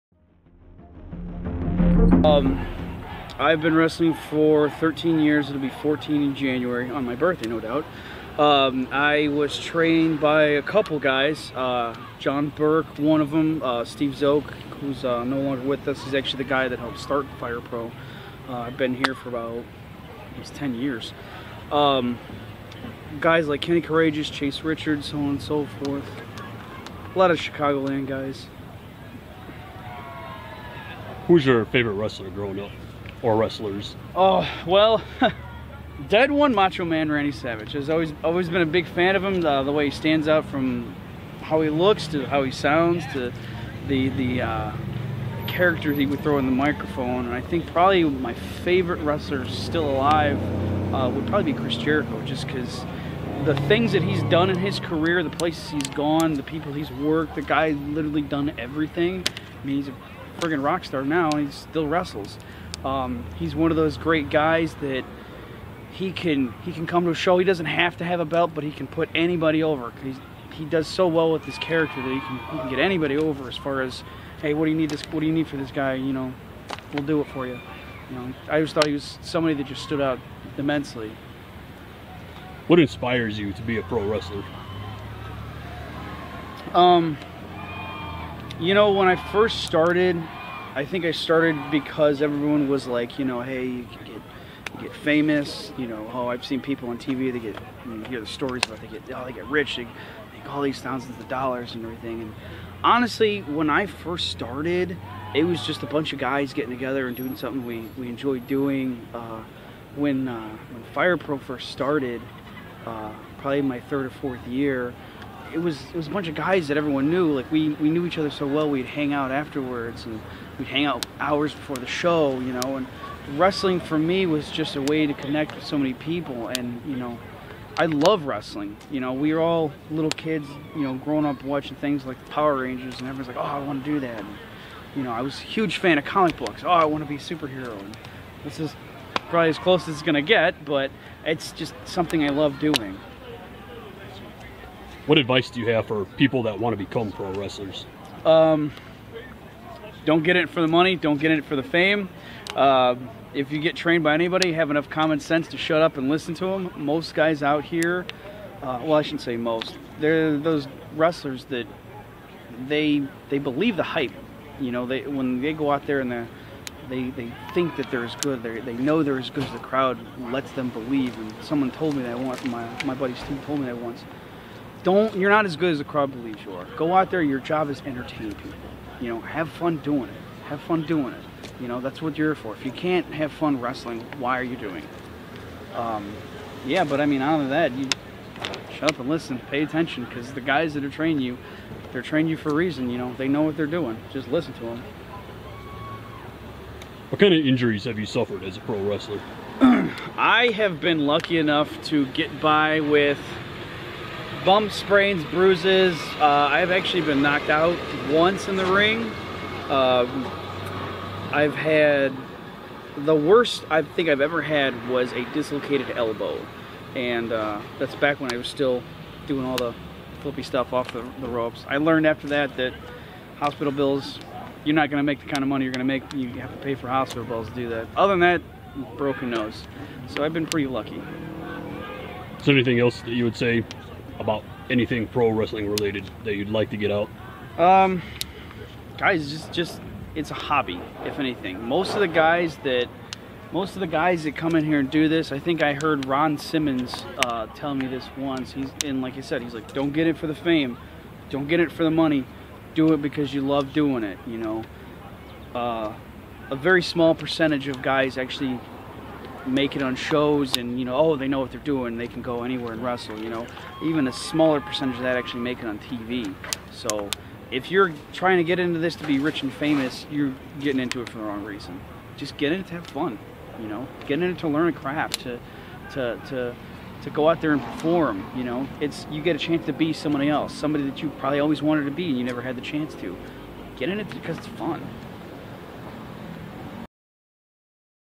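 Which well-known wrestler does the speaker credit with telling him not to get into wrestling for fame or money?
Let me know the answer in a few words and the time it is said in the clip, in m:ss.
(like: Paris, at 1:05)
Ron Simmons, at 4:06.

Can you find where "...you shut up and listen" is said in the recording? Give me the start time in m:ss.
3:07.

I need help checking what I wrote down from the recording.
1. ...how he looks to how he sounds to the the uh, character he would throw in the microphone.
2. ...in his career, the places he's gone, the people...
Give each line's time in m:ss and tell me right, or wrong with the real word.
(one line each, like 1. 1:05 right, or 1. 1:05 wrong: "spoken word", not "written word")
1. 0:41 right
2. 0:54 right.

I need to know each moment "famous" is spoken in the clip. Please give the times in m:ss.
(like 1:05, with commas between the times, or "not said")
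1:34, 4:29.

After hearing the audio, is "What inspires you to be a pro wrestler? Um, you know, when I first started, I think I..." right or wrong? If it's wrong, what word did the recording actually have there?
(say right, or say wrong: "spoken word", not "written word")
right.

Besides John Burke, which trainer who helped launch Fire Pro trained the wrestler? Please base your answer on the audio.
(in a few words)
Steve Zoke.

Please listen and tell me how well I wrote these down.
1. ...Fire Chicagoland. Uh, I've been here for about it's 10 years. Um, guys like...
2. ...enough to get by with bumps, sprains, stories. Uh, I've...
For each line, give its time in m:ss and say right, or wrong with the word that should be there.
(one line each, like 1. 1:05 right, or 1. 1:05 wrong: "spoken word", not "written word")
1. 0:17 wrong: "Pro", not "Chicagoland"
2. 3:21 wrong: "bruises", not "stories".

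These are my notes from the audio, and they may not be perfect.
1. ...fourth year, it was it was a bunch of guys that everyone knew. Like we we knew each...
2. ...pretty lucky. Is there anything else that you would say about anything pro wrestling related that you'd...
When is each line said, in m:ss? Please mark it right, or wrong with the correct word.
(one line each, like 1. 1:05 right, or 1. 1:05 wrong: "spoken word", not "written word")
1. 1:54 right
2. 3:50 right.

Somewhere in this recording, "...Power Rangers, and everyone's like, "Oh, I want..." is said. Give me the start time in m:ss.
2:12.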